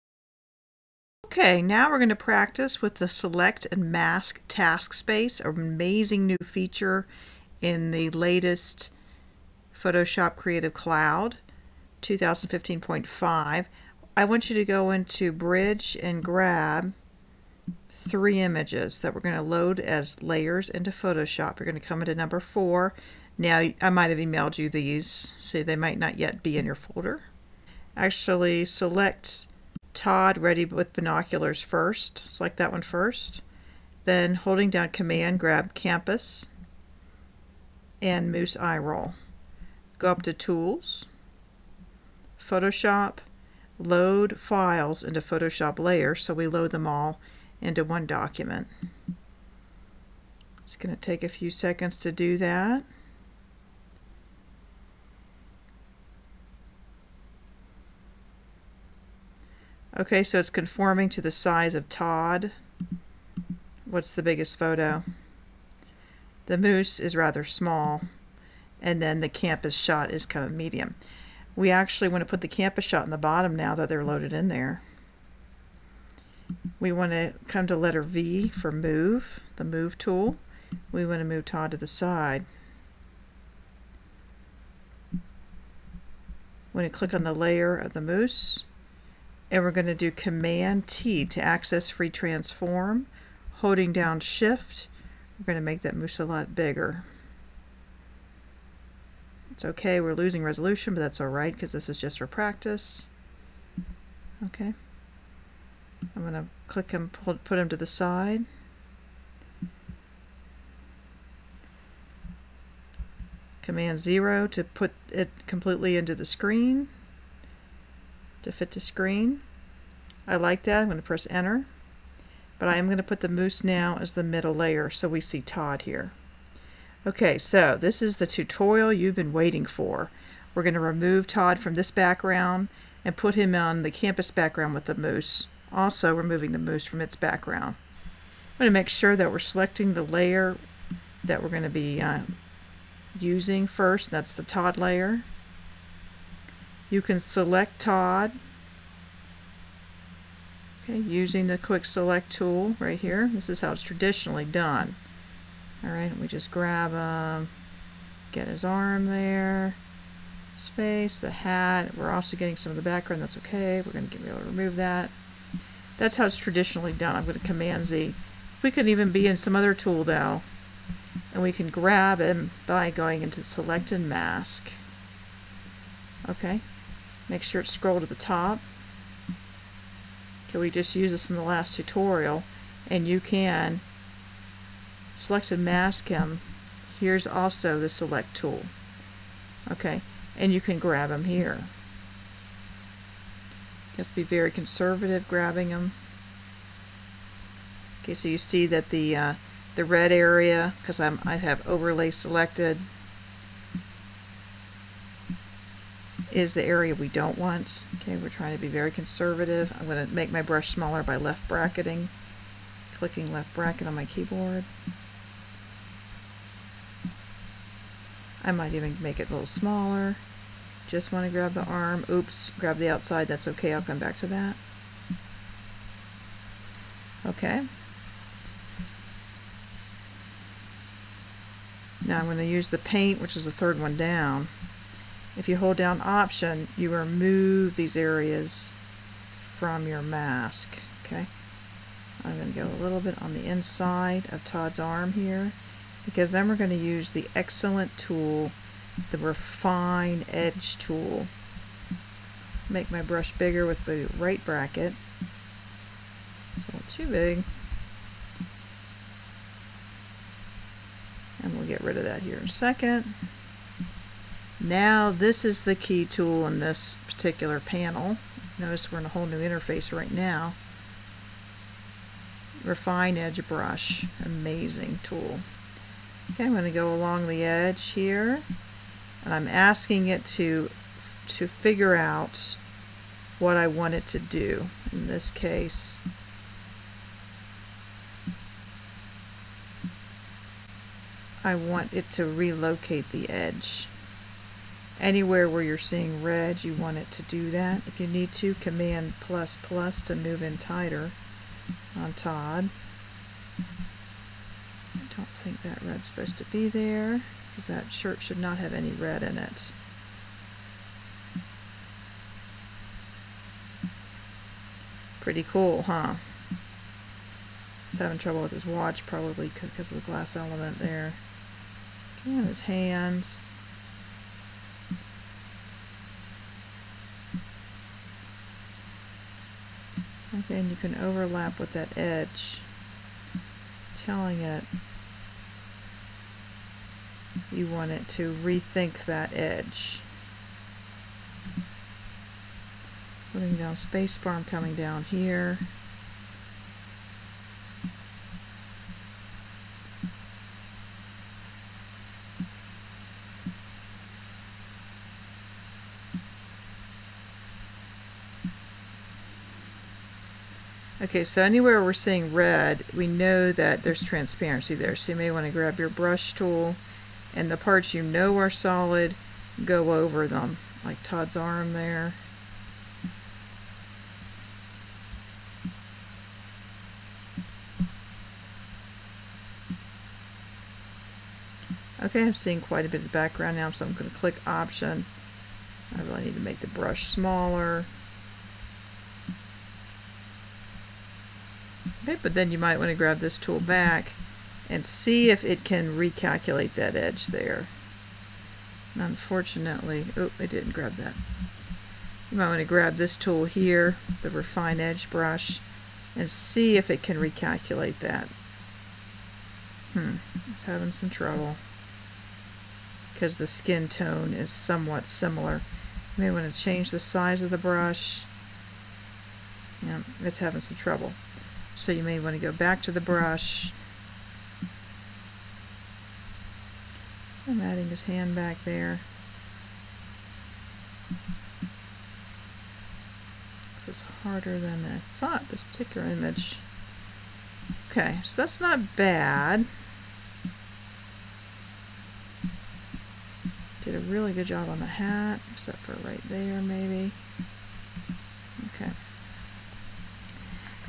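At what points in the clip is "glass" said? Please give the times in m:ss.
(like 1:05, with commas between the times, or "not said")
5:20.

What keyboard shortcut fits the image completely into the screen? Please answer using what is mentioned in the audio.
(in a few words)
Command 0.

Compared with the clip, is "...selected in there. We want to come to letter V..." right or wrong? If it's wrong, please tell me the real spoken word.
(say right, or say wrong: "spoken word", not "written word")
wrong: "loaded", not "selected".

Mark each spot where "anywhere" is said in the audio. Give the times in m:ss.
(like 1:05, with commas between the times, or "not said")
4:55, 6:01.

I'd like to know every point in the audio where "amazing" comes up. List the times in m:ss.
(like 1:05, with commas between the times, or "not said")
0:05, 4:34.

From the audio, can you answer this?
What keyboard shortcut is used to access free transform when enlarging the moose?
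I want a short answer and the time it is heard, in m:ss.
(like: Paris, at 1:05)
Command T, at 1:30.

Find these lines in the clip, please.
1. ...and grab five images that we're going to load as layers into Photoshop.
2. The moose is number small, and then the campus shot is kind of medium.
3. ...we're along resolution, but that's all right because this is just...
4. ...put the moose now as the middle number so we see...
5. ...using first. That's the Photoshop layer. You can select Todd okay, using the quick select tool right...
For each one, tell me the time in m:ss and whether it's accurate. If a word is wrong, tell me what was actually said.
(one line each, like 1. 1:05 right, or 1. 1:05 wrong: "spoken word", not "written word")
1. 0:16 wrong: "three", not "five"
2. 1:06 wrong: "rather", not "number"
3. 1:40 wrong: "losing", not "along"
4. 2:03 wrong: "layer", not "number"
5. 2:23 wrong: "Todd", not "Photoshop".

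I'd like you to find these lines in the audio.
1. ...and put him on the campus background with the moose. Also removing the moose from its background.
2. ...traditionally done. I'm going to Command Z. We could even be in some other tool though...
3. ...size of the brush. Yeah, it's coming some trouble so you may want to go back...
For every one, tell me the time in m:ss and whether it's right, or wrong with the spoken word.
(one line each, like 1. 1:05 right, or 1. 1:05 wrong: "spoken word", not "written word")
1. 2:13 right
2. 2:46 right
3. 6:56 wrong: "having", not "coming".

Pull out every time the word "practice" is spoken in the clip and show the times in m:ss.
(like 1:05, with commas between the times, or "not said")
0:02, 1:42.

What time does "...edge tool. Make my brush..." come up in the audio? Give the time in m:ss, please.
4:10.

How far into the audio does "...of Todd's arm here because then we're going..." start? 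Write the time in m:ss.
4:04.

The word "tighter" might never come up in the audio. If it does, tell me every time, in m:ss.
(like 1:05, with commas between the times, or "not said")
5:00.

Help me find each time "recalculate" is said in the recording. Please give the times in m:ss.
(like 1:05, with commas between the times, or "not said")
6:35, 6:47.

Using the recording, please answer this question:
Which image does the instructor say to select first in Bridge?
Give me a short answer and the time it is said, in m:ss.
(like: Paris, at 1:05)
Todd ready with binoculars, at 0:29.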